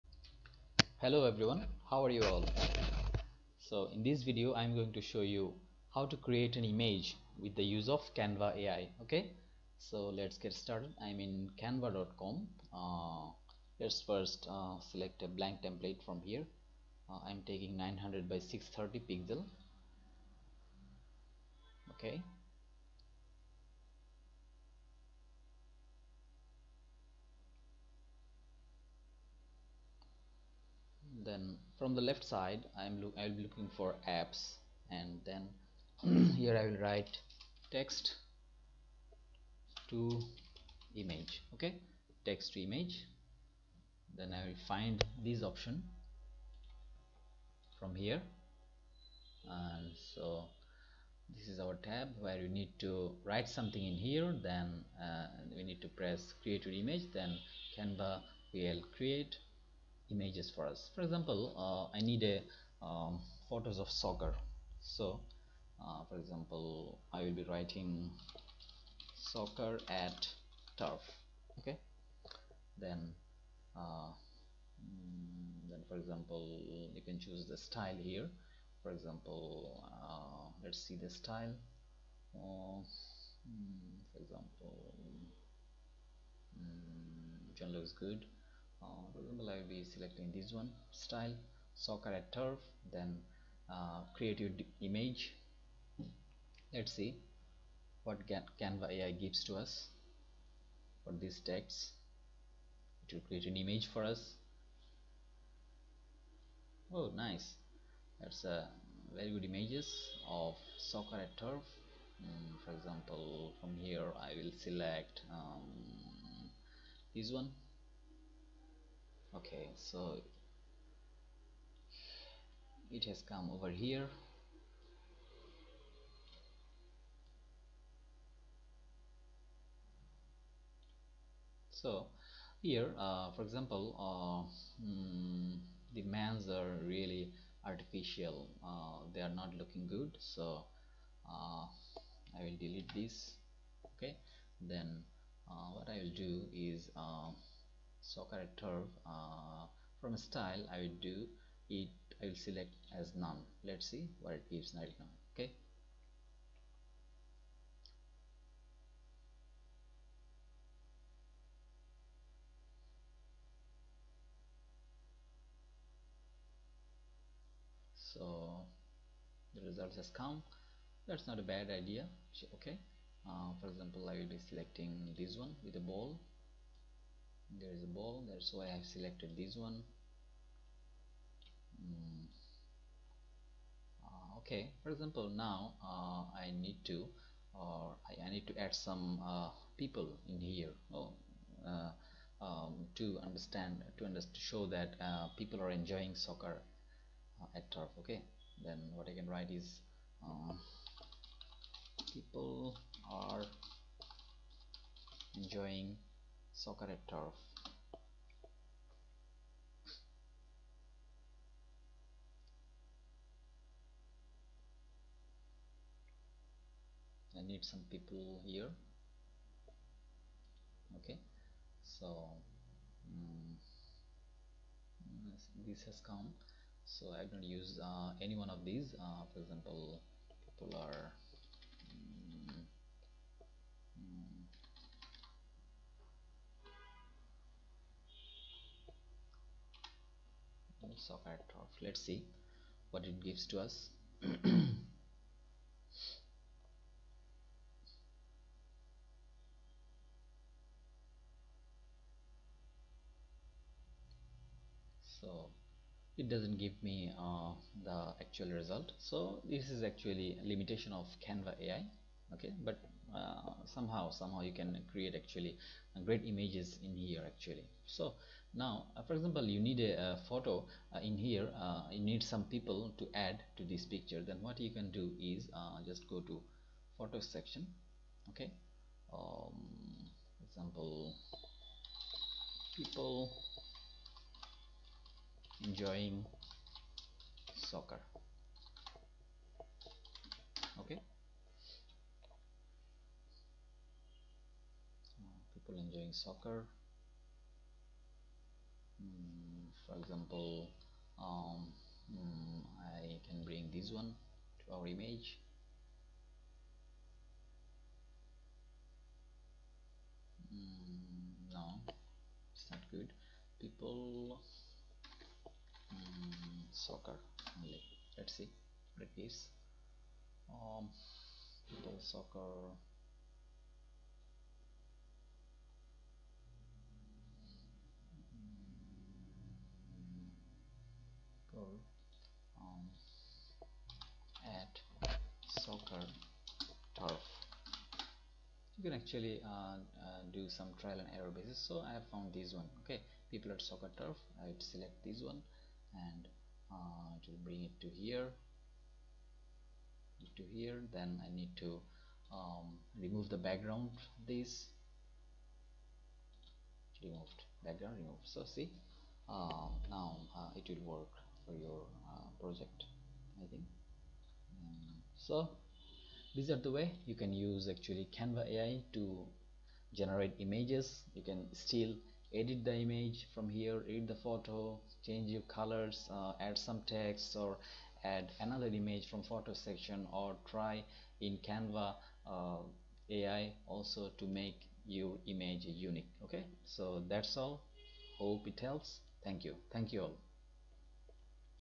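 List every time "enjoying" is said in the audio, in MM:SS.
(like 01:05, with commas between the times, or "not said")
03:15, 03:25, 04:45, 04:55.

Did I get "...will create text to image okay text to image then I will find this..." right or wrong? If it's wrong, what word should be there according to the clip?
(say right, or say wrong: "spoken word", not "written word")
wrong: "write", not "create".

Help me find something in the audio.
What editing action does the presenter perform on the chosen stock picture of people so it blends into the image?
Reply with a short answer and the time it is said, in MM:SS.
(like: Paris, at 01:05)
remove the background, at 05:52.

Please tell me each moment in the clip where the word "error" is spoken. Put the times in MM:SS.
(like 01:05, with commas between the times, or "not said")
05:41.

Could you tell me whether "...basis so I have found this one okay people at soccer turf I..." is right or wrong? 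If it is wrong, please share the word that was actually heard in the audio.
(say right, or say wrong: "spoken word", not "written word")
right.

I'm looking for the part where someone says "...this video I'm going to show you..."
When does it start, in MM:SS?
00:04.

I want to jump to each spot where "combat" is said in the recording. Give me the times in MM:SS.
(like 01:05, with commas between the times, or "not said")
not said.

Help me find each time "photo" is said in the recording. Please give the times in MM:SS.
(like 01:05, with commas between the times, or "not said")
01:03, 04:30, 04:36, 06:14, 06:19.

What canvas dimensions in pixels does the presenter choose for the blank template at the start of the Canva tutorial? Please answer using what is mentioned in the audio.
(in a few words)
900 by 630.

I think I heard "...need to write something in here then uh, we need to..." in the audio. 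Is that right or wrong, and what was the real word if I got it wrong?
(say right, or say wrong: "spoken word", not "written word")
right.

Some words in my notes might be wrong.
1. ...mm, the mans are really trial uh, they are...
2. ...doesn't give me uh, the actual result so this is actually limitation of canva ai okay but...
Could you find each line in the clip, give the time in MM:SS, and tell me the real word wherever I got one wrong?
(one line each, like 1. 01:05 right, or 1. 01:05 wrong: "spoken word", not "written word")
1. 02:14 wrong: "artificial", not "trial"
2. 04:16 right.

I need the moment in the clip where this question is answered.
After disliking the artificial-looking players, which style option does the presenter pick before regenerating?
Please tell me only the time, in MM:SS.
02:33.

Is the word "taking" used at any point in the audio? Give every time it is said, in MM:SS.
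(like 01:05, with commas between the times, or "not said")
00:17.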